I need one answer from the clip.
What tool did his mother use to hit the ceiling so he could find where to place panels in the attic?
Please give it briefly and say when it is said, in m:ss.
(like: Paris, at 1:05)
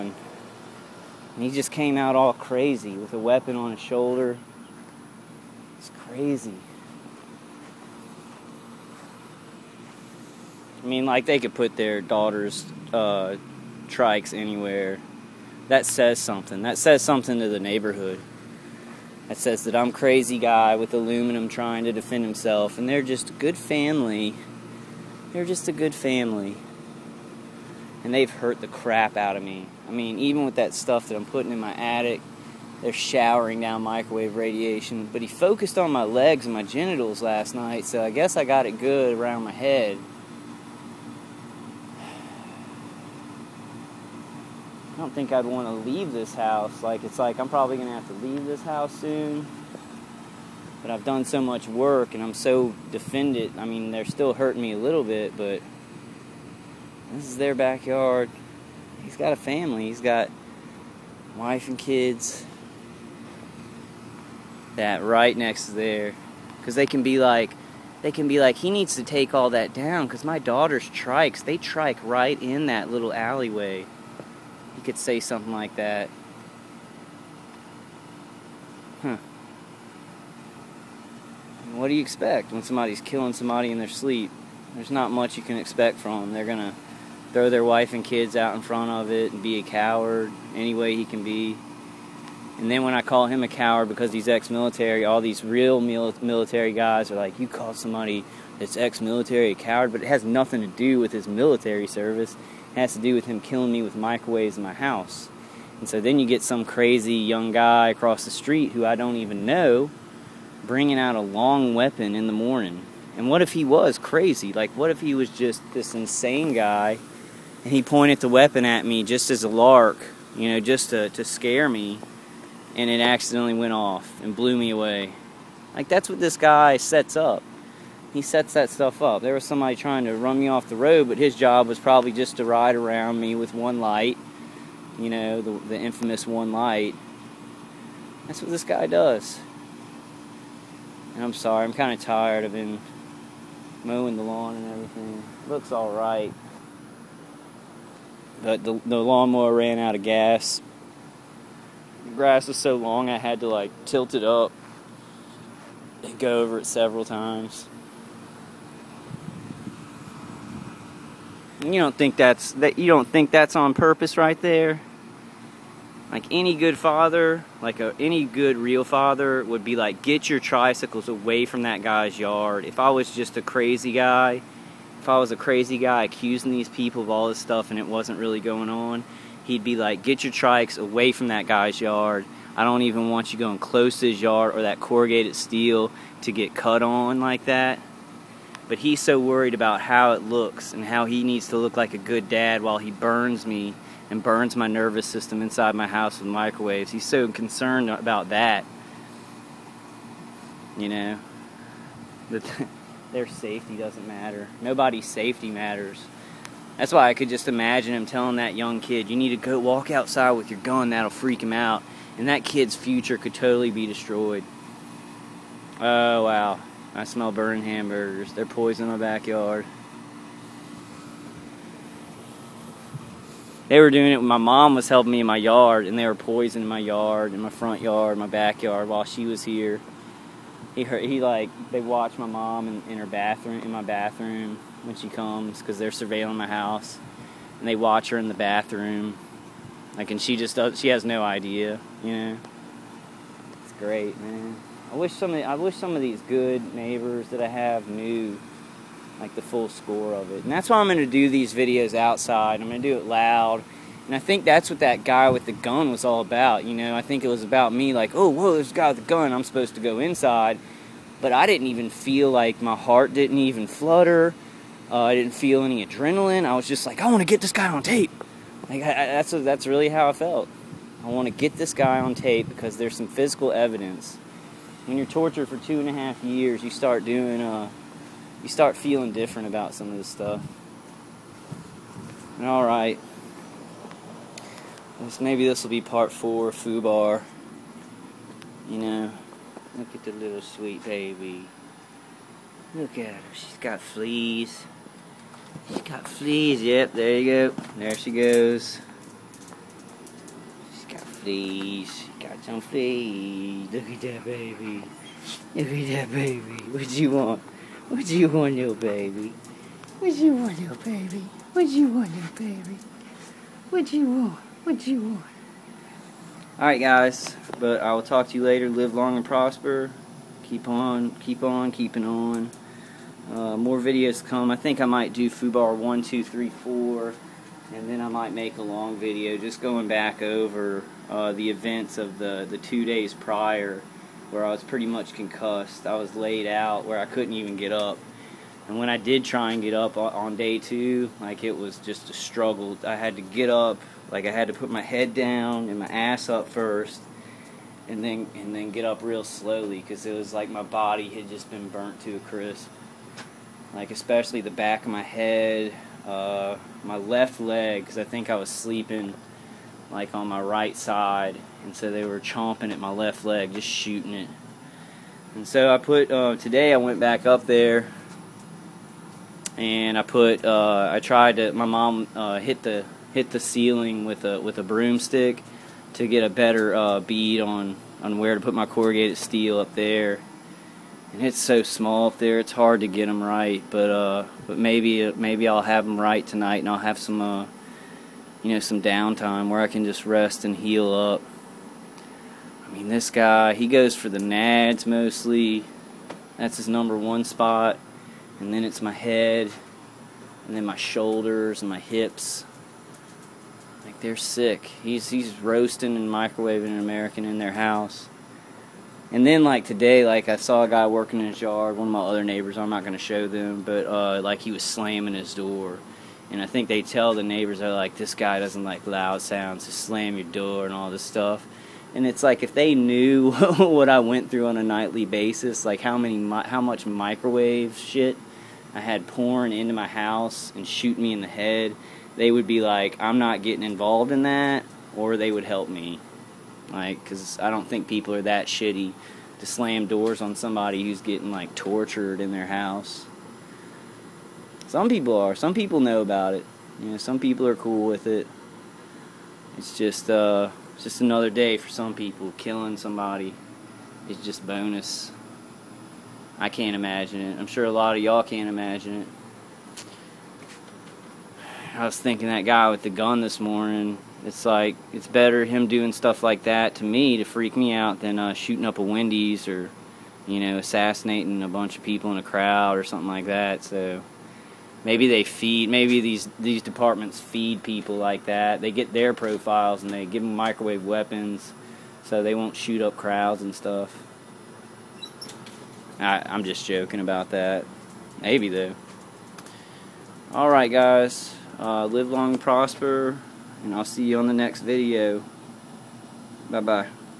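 broomstick, at 6:14.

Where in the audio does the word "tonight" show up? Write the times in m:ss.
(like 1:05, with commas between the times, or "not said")
6:26.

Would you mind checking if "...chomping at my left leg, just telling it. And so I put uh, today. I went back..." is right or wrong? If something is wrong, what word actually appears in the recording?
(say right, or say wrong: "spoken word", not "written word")
wrong: "shooting", not "telling".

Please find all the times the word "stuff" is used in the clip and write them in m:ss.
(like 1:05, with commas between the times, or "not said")
0:30, 2:08, 2:57, 4:40, 7:01, 7:45, 8:03.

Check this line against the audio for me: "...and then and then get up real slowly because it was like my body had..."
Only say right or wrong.
right.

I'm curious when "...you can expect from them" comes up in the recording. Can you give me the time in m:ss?
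1:25.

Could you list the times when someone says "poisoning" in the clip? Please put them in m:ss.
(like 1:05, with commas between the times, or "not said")
3:38, 3:46.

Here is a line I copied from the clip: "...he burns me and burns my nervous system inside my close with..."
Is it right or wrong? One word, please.
wrong.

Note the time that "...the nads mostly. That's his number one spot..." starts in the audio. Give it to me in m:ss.
6:34.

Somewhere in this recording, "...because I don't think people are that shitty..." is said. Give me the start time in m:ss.
7:17.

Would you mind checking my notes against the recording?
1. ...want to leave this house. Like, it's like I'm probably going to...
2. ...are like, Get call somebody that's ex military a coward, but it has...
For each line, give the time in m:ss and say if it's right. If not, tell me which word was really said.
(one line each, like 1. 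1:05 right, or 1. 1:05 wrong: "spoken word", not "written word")
1. 0:45 right
2. 1:37 wrong: "You", not "Get".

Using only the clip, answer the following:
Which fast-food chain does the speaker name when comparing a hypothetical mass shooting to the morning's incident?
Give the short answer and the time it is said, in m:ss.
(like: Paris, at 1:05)
Wendy's, at 7:48.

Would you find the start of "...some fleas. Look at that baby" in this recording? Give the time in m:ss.
5:02.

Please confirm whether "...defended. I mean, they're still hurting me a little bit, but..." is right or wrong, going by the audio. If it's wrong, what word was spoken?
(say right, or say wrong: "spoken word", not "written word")
right.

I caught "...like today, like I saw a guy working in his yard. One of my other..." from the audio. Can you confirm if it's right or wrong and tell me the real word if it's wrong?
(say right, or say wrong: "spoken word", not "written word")
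right.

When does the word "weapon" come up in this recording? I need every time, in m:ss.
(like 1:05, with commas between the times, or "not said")
0:03, 1:51, 1:58, 8:00.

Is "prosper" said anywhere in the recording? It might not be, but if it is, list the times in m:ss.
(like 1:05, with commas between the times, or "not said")
5:19, 8:12.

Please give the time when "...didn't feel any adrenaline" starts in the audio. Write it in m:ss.
4:25.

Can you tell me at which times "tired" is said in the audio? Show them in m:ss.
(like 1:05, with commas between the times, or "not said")
2:22.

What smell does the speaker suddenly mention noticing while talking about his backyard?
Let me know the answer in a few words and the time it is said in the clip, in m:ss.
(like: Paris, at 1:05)
burning hamburgers, at 3:37.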